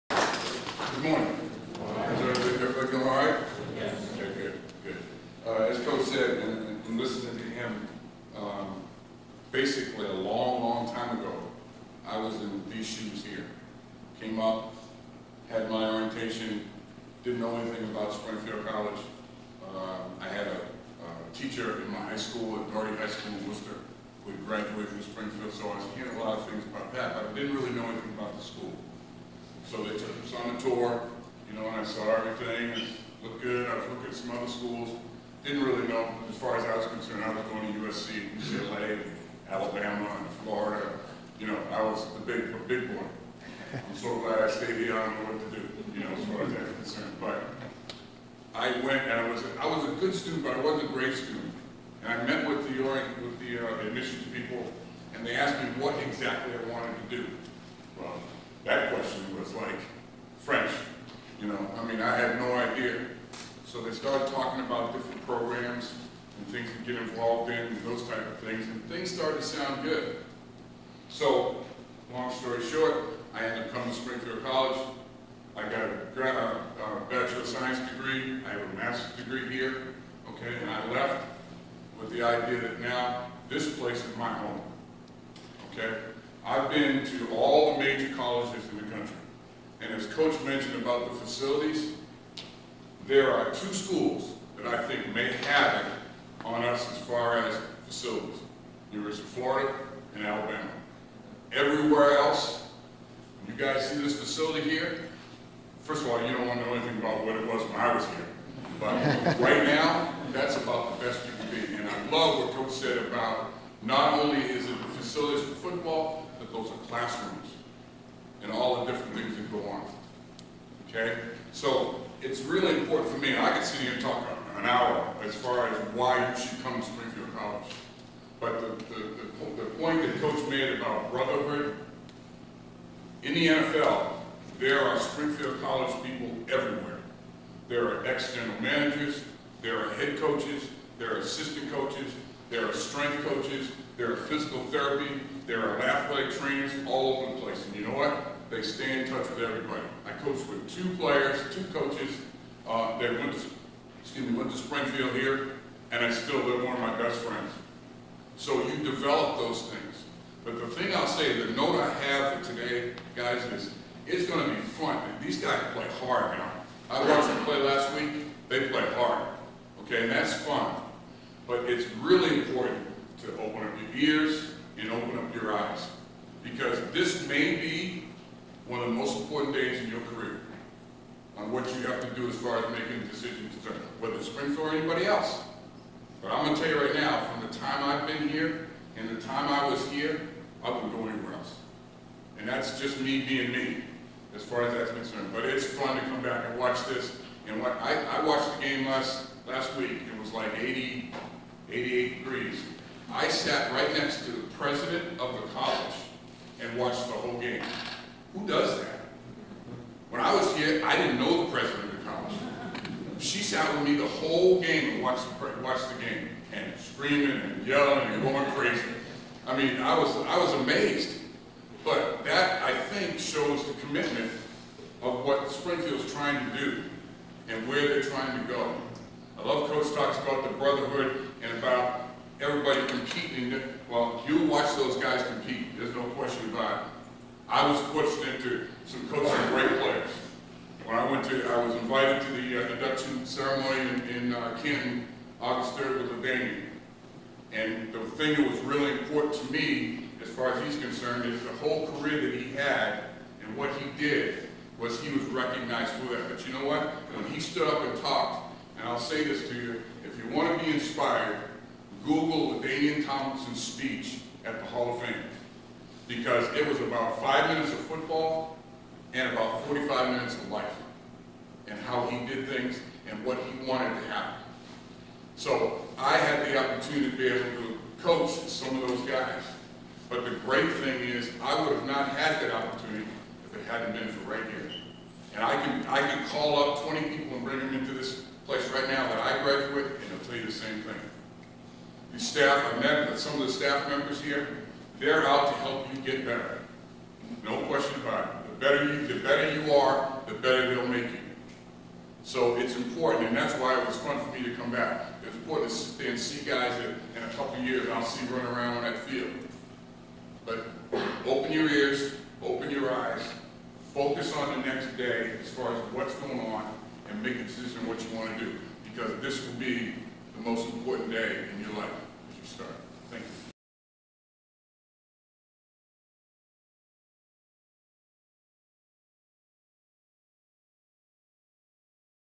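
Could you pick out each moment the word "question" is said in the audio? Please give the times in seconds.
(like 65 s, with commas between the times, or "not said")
58 s, 236 s, 297 s.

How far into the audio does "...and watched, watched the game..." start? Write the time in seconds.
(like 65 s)
214 s.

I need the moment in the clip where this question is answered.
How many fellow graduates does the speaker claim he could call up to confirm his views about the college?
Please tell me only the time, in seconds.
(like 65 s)
286 s.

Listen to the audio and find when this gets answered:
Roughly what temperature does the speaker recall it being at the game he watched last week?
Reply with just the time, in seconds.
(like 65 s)
201 s.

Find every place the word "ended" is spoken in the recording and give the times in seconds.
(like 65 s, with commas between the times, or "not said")
73 s.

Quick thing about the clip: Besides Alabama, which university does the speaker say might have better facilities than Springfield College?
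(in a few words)
University of Florida.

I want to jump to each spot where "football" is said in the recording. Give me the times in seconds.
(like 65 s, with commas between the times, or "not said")
115 s, 267 s.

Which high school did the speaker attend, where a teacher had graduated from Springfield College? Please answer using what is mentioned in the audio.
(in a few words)
Doherty High School.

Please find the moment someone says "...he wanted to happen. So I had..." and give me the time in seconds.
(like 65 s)
273 s.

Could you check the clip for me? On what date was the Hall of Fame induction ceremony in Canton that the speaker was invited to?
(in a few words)
August 3rd.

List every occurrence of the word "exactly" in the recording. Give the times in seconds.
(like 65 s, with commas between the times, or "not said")
56 s.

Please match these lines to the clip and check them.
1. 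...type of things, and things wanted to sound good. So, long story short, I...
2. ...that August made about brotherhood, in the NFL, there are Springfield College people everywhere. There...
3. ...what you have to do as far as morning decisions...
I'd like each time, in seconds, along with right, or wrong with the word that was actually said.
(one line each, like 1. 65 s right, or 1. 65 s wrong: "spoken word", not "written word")
1. 68 s wrong: "started", not "wanted"
2. 130 s wrong: "Coach", not "August"
3. 181 s wrong: "making", not "morning".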